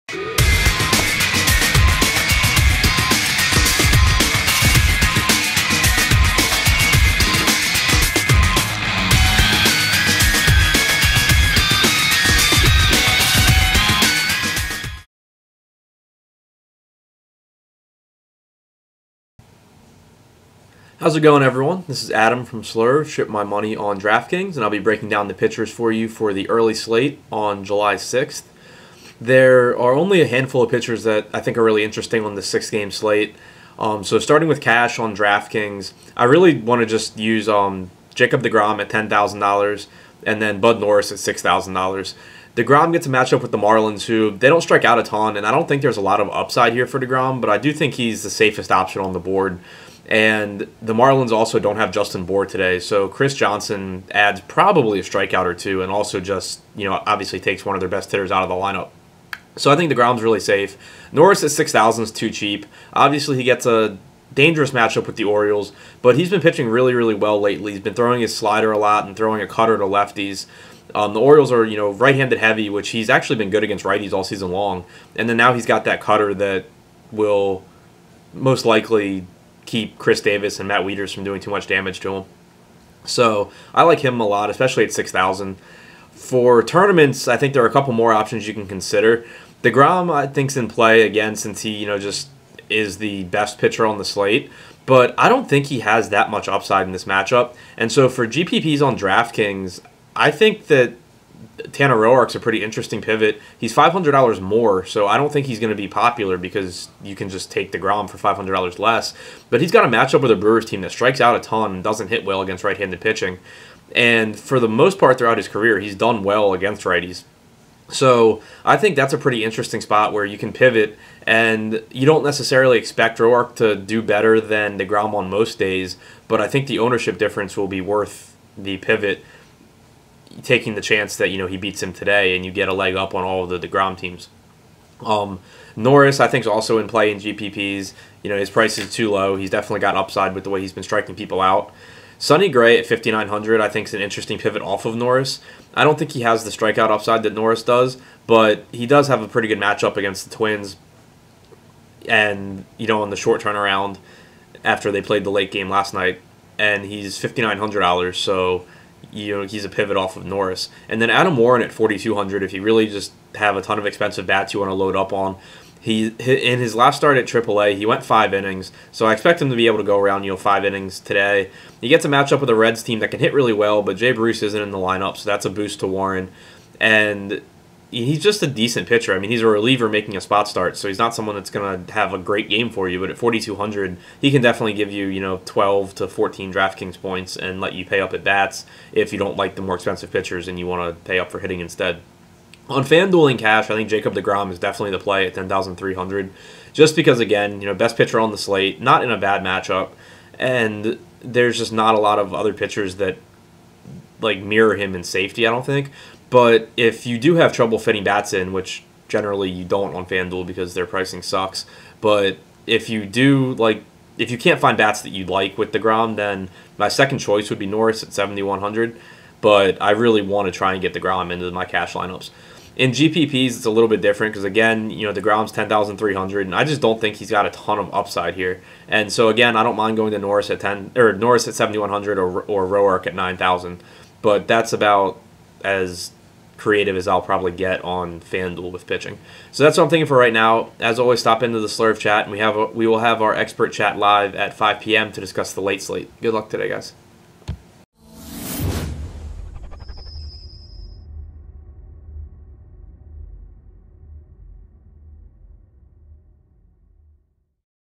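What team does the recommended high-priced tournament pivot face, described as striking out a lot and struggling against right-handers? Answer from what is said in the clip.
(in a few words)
Brewers.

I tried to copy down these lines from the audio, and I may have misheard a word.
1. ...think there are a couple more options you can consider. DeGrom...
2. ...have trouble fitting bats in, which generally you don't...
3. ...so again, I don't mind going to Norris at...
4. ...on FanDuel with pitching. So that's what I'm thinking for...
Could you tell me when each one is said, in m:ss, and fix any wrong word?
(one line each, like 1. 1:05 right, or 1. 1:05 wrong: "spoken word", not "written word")
1. 1:27 right
2. 3:27 right
3. 3:49 right
4. 3:57 right.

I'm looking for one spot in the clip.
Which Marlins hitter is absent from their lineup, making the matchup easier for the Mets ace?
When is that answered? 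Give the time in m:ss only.
0:51.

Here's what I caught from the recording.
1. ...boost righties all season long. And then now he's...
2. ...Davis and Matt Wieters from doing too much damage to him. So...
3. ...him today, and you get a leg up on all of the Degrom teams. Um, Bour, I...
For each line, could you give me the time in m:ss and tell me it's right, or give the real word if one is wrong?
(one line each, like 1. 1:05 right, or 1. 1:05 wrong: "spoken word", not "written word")
1. 1:13 wrong: "against", not "boost"
2. 1:20 right
3. 2:11 wrong: "Norris", not "Bour".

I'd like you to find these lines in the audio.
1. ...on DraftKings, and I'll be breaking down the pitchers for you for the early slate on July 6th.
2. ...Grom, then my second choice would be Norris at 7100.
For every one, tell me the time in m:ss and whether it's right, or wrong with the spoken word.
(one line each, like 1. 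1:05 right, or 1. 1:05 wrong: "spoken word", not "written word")
1. 0:23 right
2. 3:35 right.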